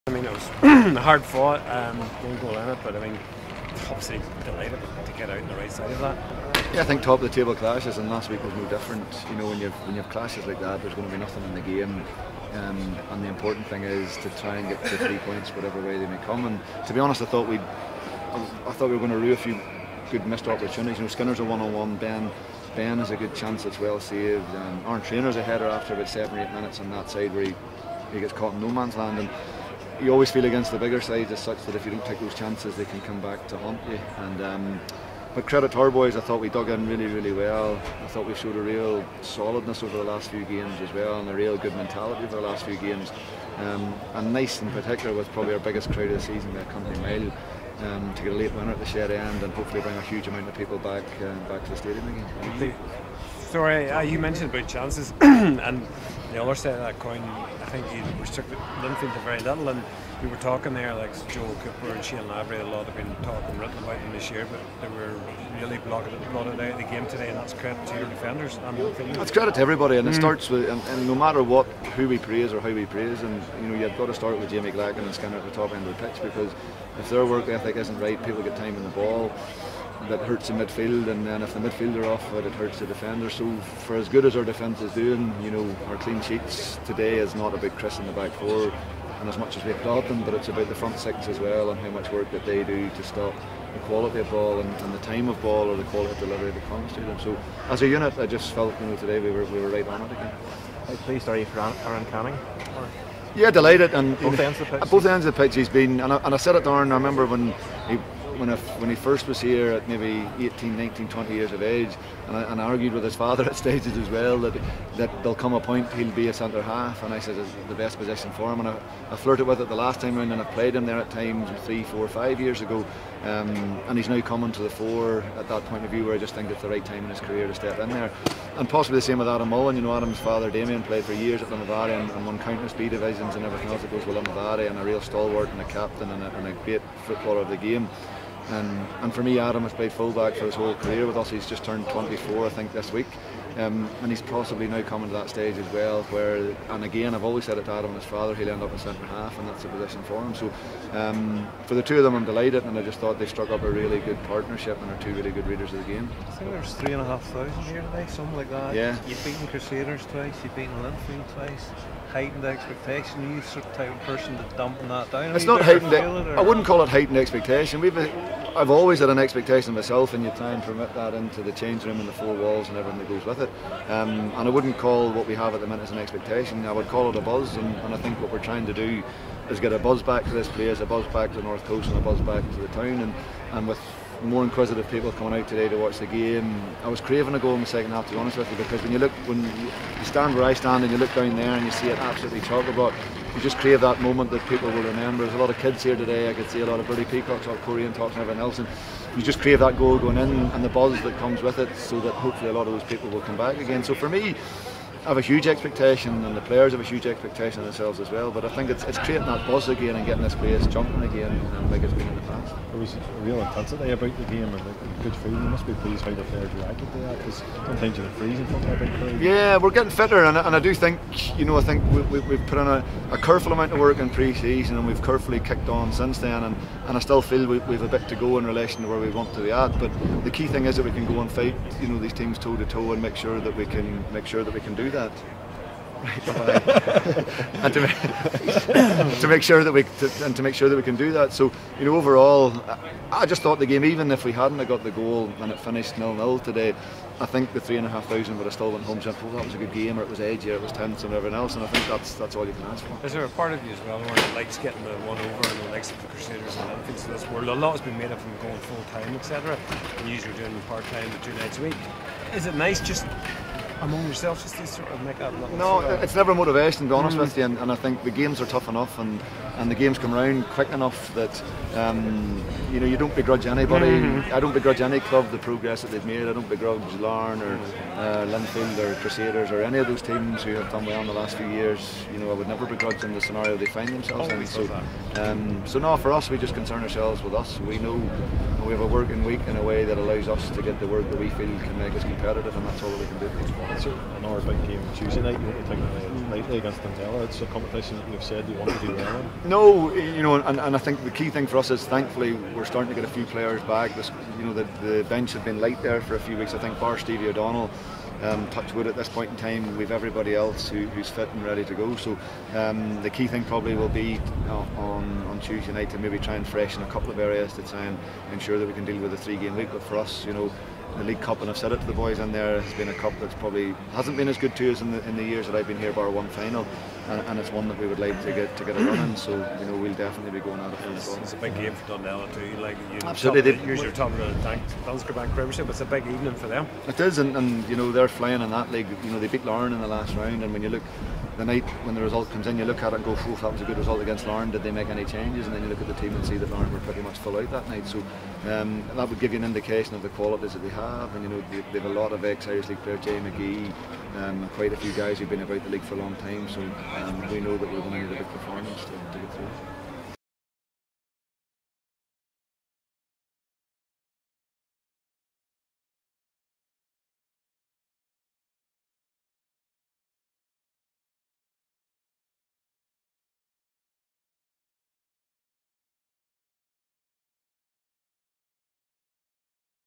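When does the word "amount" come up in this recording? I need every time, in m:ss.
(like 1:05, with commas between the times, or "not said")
0:50, 3:43.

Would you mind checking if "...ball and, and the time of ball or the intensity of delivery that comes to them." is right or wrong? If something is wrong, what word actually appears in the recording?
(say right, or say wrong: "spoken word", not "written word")
wrong: "quality", not "intensity".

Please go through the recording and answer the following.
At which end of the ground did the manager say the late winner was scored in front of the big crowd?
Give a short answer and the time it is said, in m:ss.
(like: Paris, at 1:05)
the shed end, at 0:48.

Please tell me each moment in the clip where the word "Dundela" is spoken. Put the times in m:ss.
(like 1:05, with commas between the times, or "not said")
4:56, 5:31.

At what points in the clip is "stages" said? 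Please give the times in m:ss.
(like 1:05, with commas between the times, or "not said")
1:53, 2:25.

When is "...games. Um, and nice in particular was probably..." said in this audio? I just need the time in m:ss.
0:42.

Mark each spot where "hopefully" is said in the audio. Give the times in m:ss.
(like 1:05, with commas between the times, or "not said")
0:49, 3:22.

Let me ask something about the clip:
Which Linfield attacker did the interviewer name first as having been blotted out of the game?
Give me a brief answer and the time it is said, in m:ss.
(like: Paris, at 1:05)
Joe Cooper, at 1:01.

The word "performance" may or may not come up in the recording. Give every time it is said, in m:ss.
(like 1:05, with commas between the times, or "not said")
5:58.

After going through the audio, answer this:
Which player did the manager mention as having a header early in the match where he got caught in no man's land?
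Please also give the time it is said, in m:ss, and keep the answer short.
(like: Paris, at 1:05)
Aaron Trainer, at 0:24.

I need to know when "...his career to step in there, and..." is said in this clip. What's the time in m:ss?
2:07.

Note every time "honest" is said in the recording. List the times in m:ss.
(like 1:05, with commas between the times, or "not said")
0:16, 3:08, 4:26.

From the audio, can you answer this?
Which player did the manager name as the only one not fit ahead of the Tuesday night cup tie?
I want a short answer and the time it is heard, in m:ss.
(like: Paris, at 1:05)
Stevie O'Donnell, at 5:06.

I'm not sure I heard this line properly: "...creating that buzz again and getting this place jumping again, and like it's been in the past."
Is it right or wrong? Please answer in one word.
right.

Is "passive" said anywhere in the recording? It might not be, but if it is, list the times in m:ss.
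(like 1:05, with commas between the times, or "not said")
not said.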